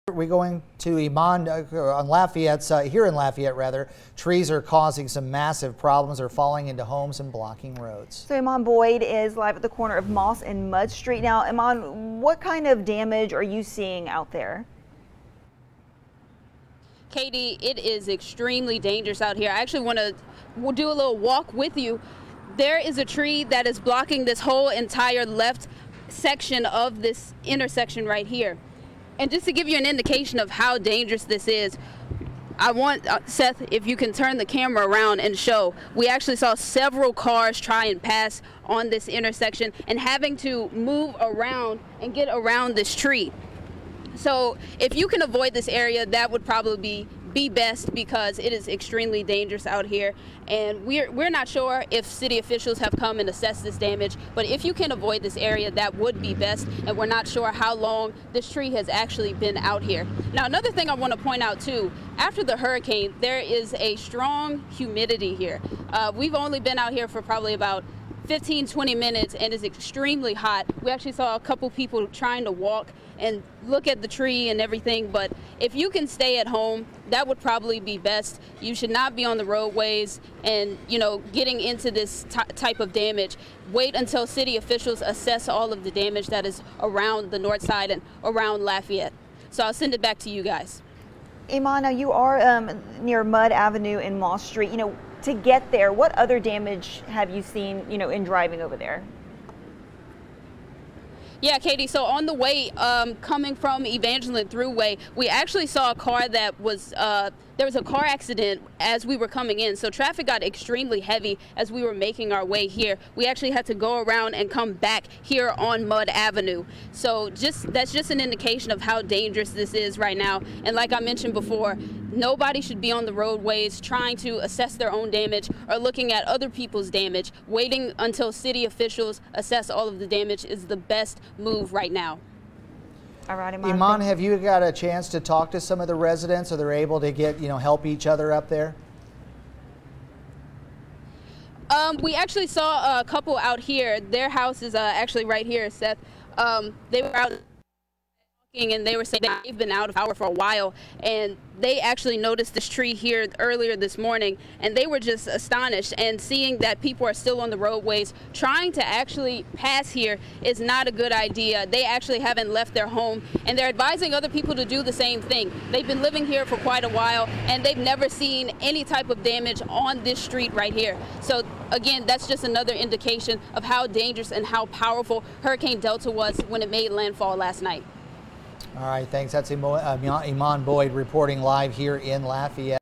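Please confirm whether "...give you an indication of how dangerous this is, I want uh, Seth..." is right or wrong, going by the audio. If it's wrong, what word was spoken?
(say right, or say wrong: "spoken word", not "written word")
right.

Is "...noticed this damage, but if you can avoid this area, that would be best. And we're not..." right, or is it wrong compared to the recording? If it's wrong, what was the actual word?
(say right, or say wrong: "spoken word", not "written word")
wrong: "assessed", not "noticed".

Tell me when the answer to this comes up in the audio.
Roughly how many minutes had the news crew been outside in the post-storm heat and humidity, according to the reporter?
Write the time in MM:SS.
01:08.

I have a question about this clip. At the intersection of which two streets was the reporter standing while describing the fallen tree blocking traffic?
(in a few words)
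Moss and Mudd Street.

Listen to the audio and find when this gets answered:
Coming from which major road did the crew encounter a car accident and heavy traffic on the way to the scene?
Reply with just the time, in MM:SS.
01:43.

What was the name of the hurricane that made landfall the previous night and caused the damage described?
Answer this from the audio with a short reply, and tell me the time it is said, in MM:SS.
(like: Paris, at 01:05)
Hurricane Delta, at 02:55.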